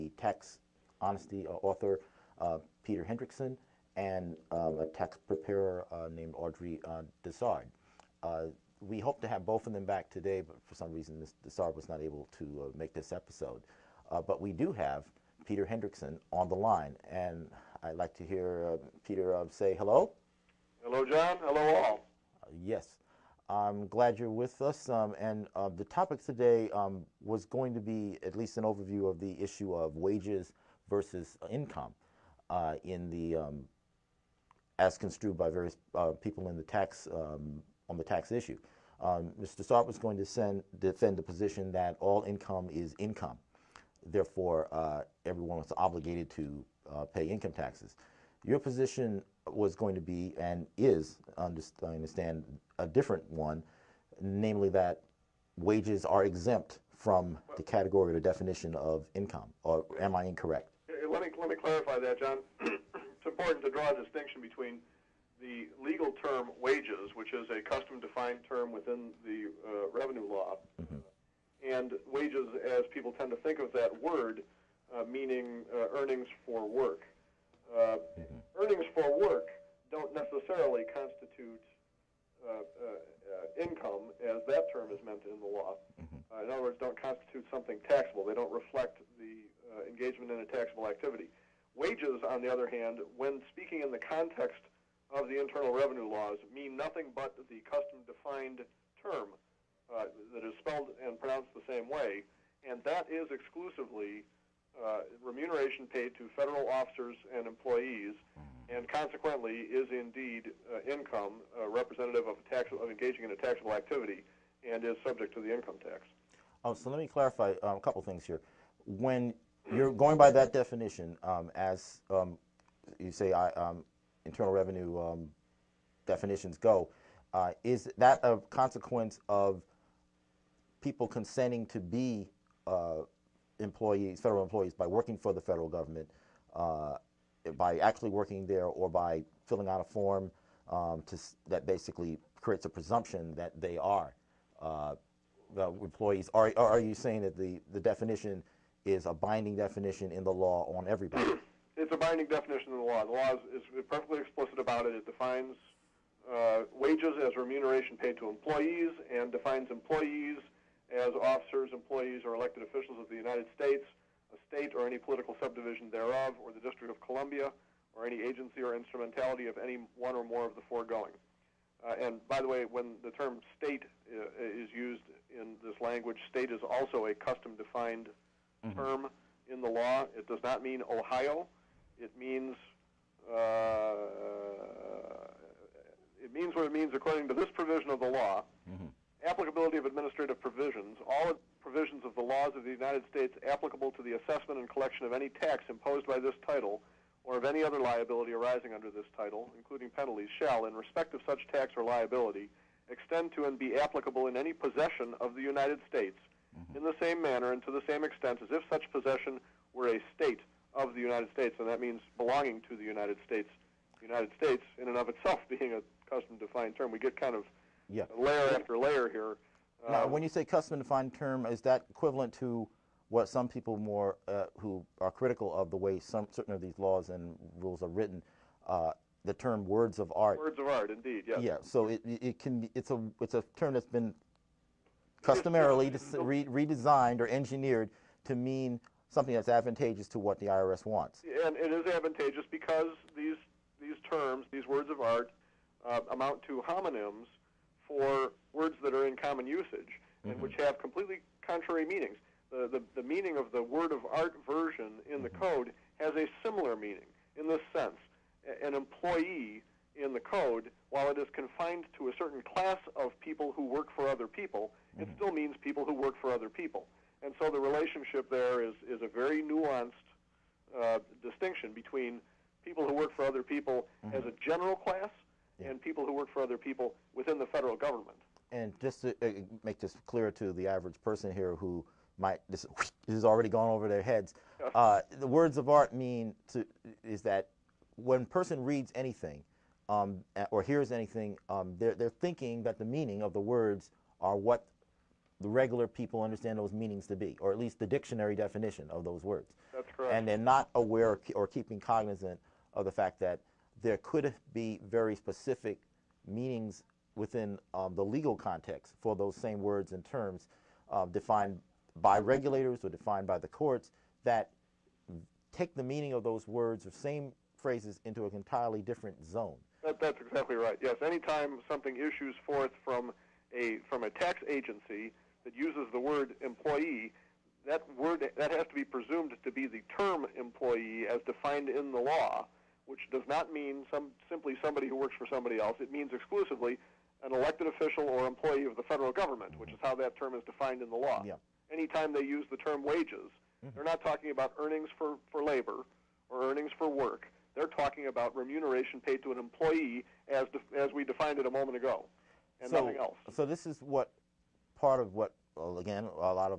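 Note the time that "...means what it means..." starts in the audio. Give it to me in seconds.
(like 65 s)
186 s.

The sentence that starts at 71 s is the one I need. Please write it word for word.
and wages, as people tend to think of that word, uh, meaning uh, earnings for work.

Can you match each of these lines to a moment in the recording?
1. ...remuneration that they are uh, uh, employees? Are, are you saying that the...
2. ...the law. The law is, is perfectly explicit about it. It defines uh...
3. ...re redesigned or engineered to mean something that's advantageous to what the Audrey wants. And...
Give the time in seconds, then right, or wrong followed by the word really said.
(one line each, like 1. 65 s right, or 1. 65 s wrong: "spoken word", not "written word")
1. 142 s wrong: "presumption", not "remuneration"
2. 152 s right
3. 236 s wrong: "IRS", not "Audrey".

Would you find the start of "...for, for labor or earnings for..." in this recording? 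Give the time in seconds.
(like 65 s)
344 s.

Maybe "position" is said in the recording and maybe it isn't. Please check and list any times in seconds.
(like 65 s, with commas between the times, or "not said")
41 s, 48 s.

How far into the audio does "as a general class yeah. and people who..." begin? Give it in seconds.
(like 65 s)
274 s.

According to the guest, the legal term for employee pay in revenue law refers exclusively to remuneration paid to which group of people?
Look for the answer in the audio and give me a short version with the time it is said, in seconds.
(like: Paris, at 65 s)
federal officers and employees, at 106 s.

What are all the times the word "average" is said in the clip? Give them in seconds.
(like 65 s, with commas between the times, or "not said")
280 s.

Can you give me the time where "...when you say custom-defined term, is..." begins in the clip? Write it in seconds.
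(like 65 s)
220 s.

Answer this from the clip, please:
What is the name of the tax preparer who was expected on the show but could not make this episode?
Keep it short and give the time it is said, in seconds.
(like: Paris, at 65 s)
Audrey Desard, at 6 s.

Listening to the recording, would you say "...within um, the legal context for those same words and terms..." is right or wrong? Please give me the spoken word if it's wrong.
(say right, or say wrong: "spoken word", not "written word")
right.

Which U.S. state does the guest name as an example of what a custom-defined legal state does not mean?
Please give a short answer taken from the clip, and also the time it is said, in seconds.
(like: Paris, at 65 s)
Ohio, at 180 s.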